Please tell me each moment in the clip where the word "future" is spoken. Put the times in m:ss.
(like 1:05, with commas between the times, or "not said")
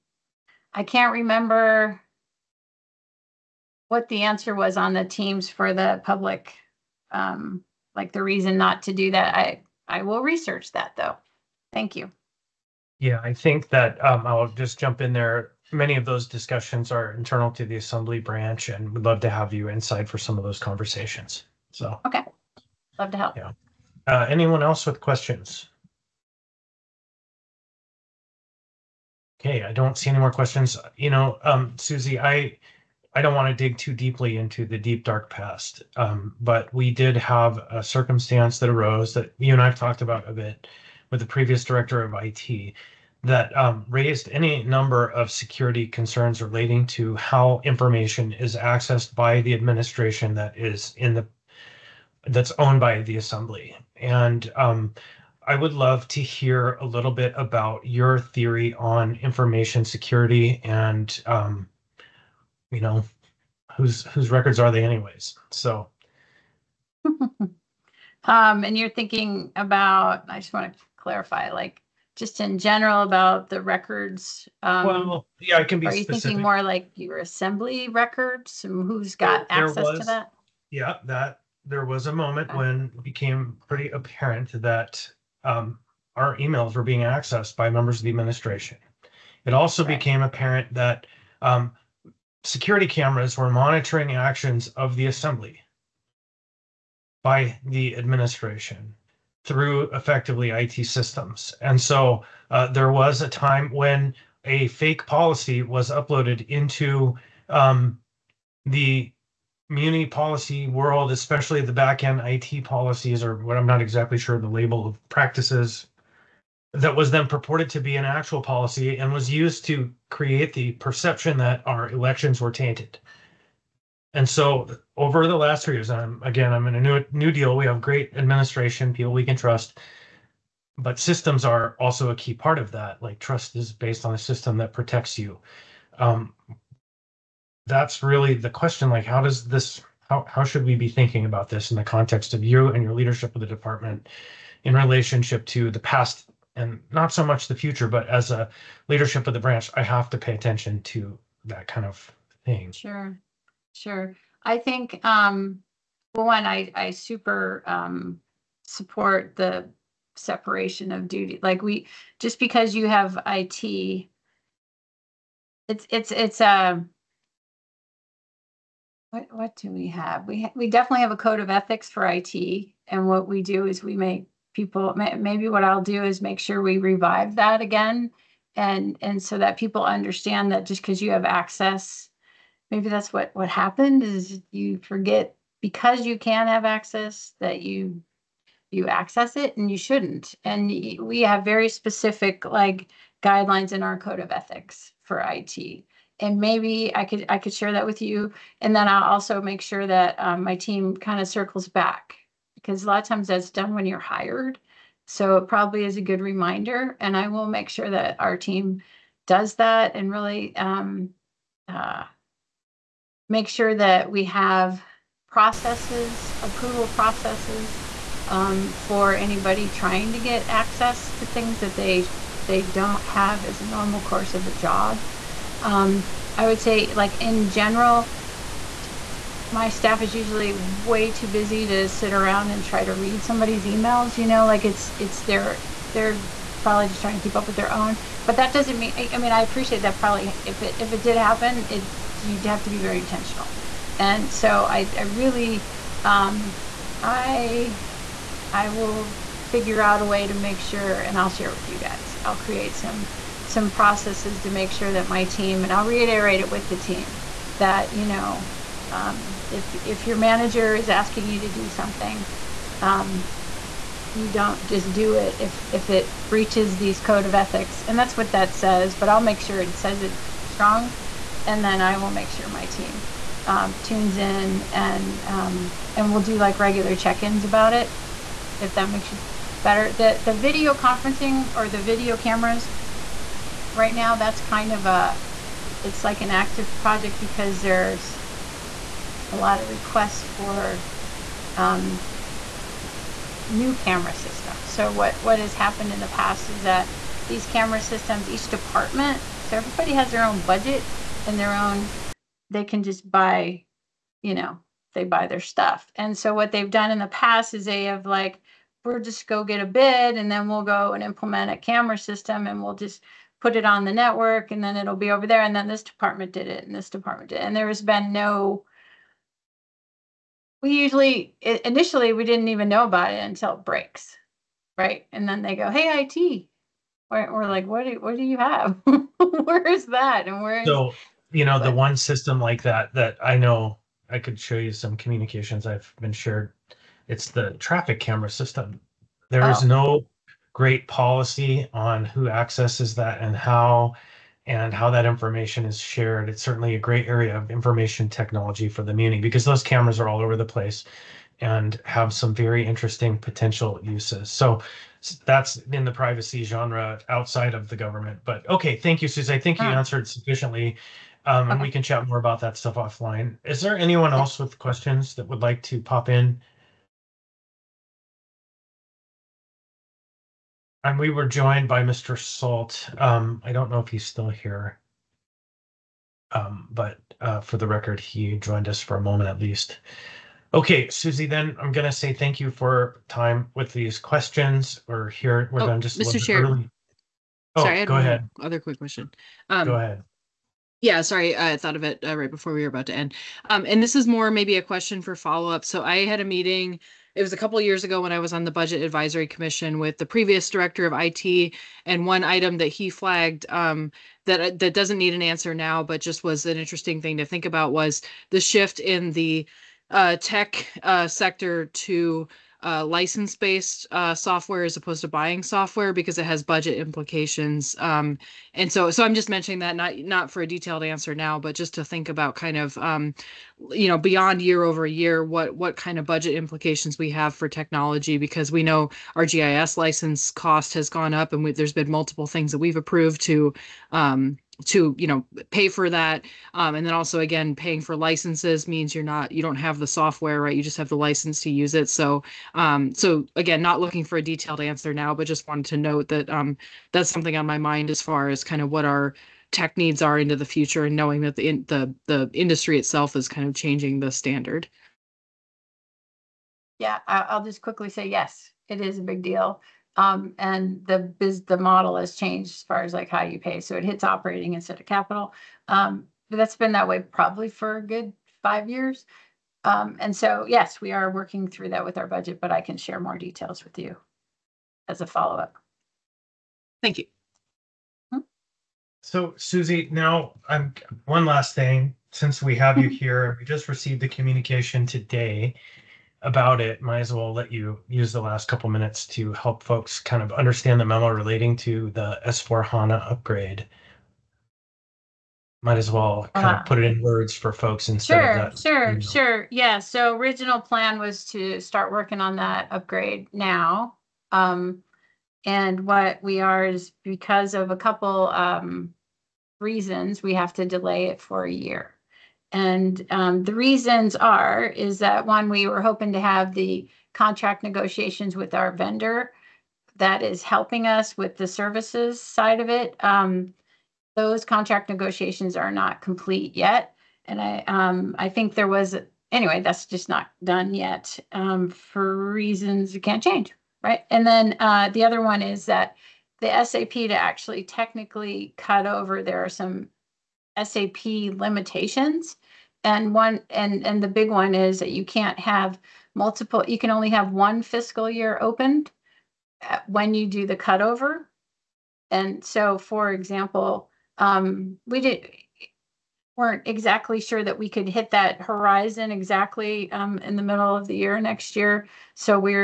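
2:27, 7:30.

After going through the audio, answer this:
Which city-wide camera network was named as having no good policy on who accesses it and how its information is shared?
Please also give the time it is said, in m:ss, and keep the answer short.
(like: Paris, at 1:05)
Traffic camera system, at 5:37.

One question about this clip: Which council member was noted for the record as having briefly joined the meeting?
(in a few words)
Mr. Salt.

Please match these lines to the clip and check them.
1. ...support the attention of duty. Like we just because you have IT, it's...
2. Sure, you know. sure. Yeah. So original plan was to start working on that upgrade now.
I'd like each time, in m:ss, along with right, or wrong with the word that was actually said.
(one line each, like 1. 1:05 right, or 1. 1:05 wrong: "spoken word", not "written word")
1. 2:38 wrong: "separation", not "attention"
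2. 8:18 right.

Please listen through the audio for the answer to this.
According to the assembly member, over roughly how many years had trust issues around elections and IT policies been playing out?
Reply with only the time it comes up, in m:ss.
2:05.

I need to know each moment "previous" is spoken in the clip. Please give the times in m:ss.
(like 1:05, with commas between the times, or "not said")
0:41, 6:40.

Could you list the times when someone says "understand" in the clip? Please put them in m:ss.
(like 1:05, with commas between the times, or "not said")
2:59, 8:10.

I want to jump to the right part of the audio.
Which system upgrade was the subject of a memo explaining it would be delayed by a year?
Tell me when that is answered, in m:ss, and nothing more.
8:12.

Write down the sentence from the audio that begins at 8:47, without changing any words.
And I, um, I think there was, anyway, that's just not done yet um, for reasons you can't change, right?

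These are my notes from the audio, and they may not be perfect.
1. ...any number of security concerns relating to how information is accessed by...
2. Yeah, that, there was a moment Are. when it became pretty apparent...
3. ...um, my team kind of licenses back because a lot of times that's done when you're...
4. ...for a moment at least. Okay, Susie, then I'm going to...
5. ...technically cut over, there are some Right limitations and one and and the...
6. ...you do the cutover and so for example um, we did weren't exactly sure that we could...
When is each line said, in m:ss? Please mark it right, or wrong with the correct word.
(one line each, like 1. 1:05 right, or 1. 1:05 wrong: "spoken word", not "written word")
1. 0:44 right
2. 1:20 wrong: "Okay", not "Are"
3. 3:20 wrong: "circles", not "licenses"
4. 6:18 right
5. 8:57 wrong: "SAP", not "Right"
6. 9:10 right.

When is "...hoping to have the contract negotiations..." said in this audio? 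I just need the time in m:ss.
8:35.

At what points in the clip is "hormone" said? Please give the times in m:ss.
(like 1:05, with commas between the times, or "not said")
not said.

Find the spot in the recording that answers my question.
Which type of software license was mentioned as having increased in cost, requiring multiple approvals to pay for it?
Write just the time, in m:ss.
7:09.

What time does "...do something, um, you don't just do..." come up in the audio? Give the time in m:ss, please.
4:21.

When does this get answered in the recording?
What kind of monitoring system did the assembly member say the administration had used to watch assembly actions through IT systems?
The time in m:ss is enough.
1:32.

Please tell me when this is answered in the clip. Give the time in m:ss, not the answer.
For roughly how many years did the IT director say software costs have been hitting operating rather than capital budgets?
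7:48.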